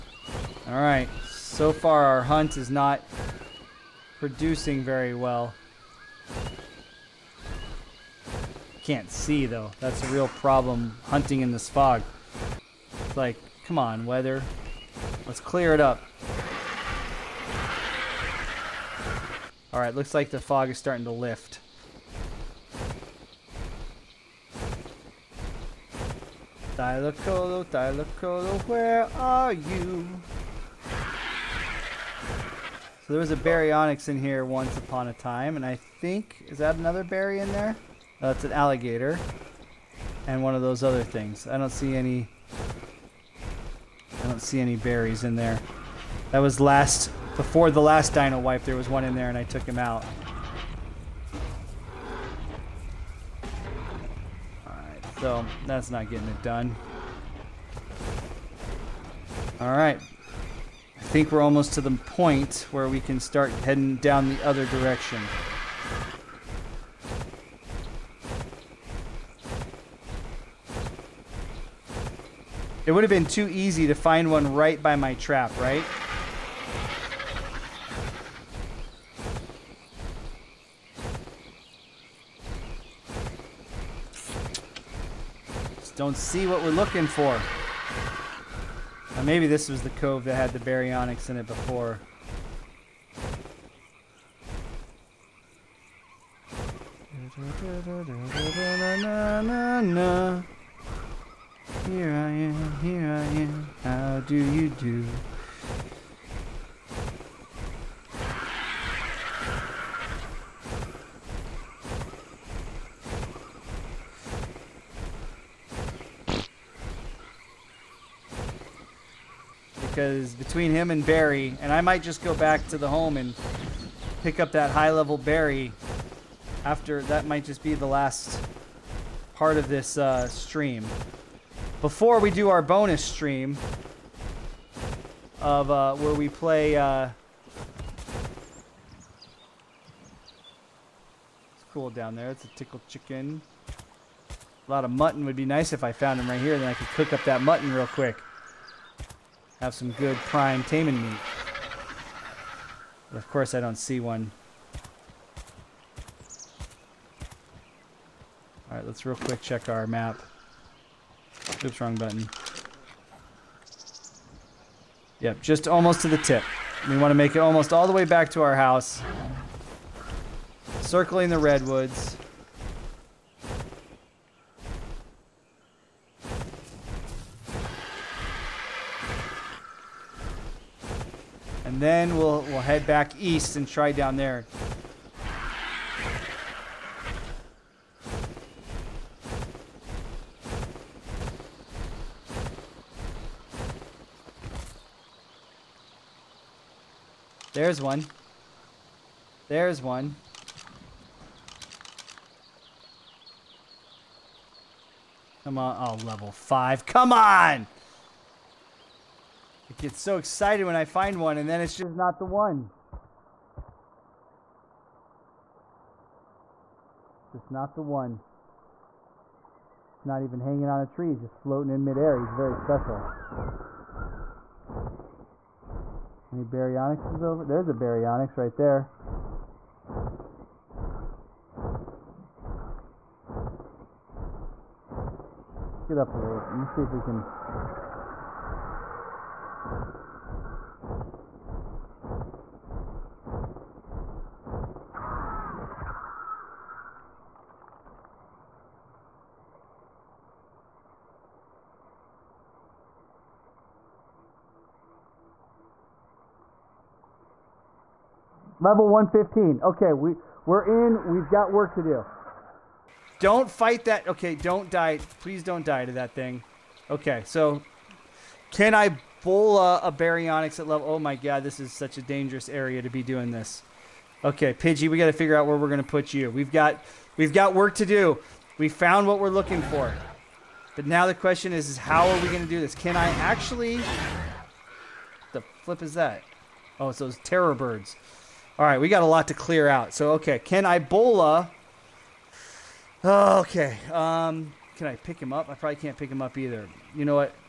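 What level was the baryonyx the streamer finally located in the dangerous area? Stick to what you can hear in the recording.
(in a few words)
115.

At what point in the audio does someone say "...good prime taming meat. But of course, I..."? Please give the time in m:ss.
2:29.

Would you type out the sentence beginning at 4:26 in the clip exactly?
Okay, so can I bola a, a baryonyx at level...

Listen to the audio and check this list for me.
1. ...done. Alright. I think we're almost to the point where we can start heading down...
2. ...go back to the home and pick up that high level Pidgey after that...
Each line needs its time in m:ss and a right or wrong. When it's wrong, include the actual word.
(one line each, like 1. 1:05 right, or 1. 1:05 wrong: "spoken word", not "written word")
1. 0:56 right
2. 2:02 wrong: "Bary", not "Pidgey".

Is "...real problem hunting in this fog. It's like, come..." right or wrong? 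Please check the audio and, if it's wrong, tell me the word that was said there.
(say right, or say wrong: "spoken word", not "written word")
right.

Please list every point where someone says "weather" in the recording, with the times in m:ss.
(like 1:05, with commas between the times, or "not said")
0:14.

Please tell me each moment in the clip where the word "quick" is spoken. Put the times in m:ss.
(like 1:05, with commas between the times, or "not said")
2:27, 2:39.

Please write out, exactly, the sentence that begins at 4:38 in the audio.
We found what we're looking for.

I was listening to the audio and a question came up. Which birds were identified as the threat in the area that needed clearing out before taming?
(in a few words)
Terror birds.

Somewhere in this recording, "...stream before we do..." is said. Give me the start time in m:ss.
2:10.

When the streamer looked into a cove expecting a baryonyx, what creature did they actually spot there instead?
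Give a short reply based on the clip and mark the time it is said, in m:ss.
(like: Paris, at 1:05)
Alligator, at 0:38.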